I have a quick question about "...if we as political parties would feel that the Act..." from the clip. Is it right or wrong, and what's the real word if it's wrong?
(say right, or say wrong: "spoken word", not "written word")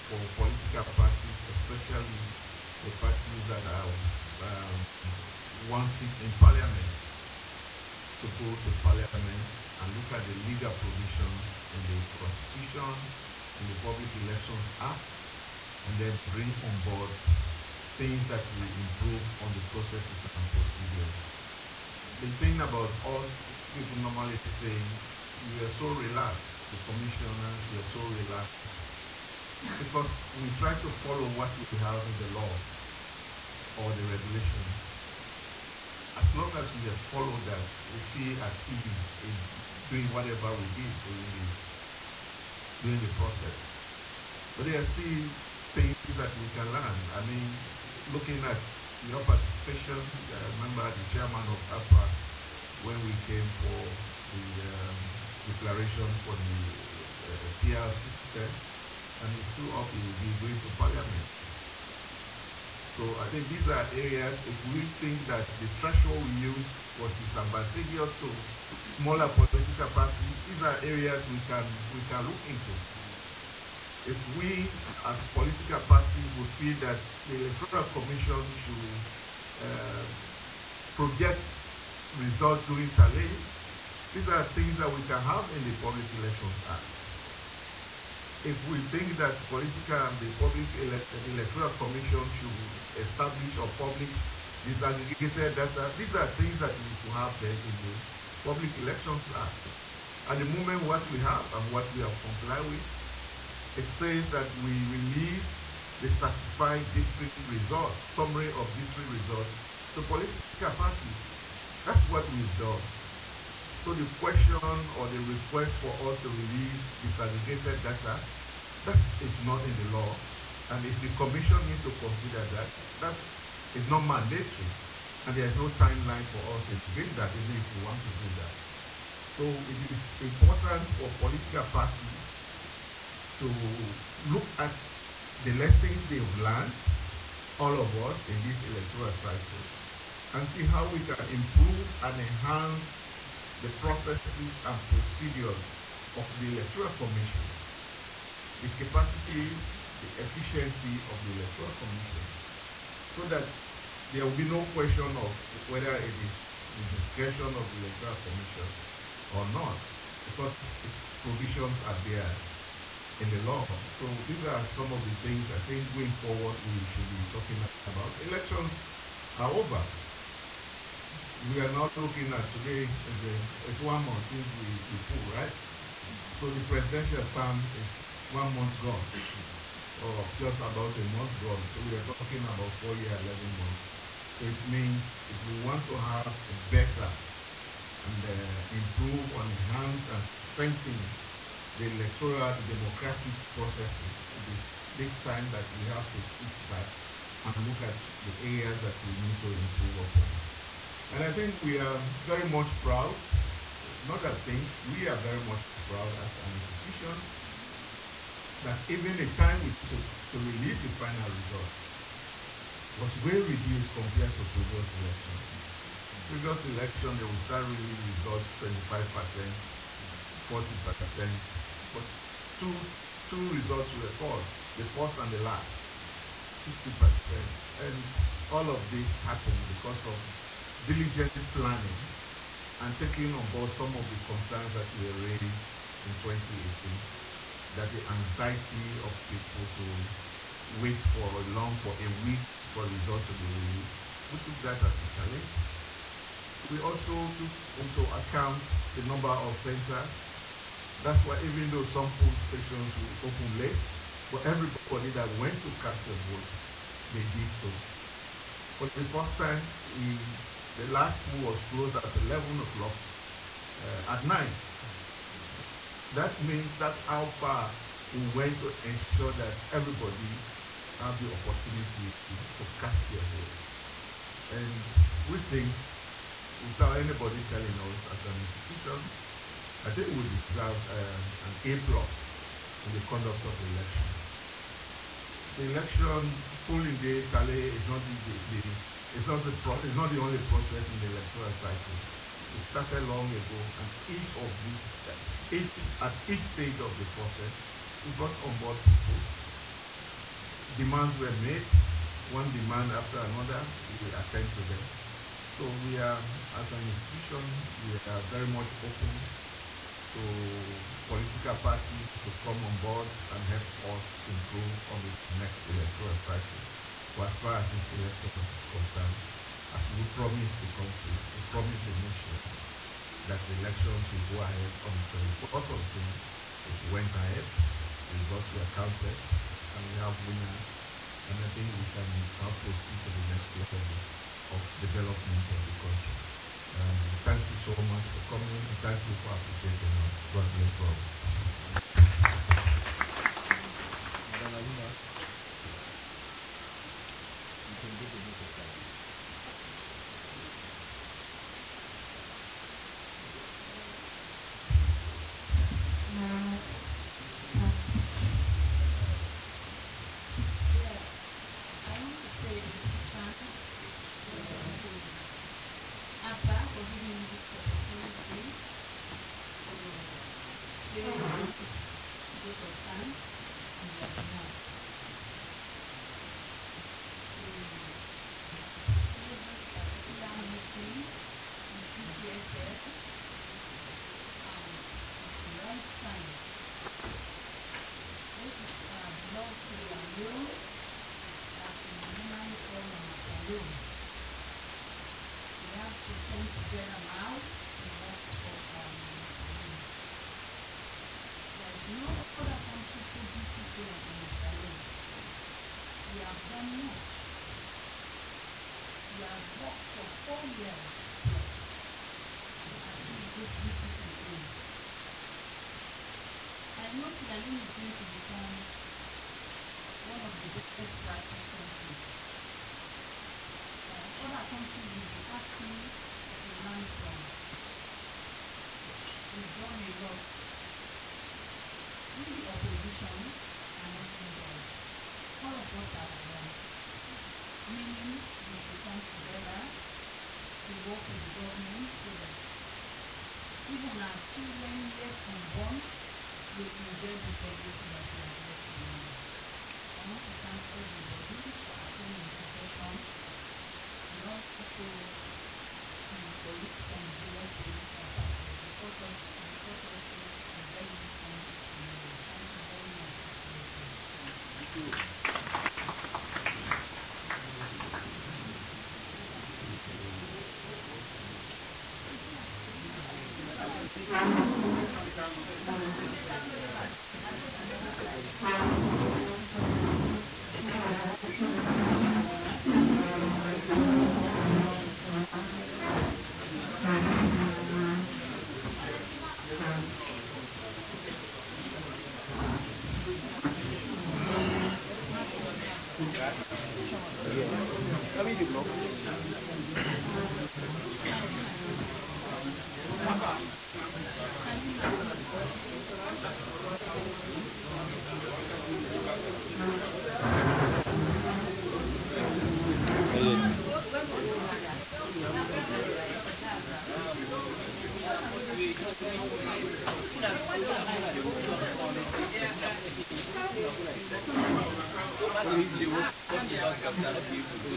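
wrong: "Electoral", not "Act".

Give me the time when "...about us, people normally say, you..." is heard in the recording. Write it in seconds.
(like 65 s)
22 s.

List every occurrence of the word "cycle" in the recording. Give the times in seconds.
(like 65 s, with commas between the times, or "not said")
139 s, 291 s, 316 s.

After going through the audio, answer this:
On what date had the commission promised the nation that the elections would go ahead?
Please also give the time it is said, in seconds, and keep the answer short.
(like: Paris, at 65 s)
24th of June, at 325 s.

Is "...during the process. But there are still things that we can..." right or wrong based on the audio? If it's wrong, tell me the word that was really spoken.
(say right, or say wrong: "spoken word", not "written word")
right.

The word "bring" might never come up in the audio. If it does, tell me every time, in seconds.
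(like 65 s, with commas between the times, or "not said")
16 s, 126 s.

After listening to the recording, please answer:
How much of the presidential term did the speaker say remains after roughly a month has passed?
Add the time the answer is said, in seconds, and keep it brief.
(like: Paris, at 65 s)
4 years, 11 months, at 182 s.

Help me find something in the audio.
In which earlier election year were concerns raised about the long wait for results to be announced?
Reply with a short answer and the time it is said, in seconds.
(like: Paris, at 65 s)
2018, at 236 s.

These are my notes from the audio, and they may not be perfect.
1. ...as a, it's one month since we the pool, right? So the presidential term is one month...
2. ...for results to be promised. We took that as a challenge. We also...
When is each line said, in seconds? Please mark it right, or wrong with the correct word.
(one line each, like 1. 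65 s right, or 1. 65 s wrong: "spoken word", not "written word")
1. 173 s right
2. 242 s wrong: "released", not "promised".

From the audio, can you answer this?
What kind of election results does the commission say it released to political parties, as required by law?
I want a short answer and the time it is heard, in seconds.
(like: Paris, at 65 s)
certified district results, at 106 s.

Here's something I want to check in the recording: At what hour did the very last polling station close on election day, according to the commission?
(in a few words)
11 o'clock at night.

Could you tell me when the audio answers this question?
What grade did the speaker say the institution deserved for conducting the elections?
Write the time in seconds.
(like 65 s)
281 s.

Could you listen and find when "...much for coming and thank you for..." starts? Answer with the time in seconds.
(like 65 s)
337 s.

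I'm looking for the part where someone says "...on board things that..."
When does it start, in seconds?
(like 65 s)
16 s.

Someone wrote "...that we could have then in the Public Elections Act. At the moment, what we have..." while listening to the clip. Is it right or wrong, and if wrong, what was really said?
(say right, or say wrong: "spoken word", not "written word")
right.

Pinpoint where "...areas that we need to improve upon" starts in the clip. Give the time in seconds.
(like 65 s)
198 s.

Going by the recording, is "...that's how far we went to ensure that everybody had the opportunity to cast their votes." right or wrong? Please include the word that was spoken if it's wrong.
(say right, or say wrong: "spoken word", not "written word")
right.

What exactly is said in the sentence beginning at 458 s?
The photos, the photo states a very big thank you to you.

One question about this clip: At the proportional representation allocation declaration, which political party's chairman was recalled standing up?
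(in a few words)
APA.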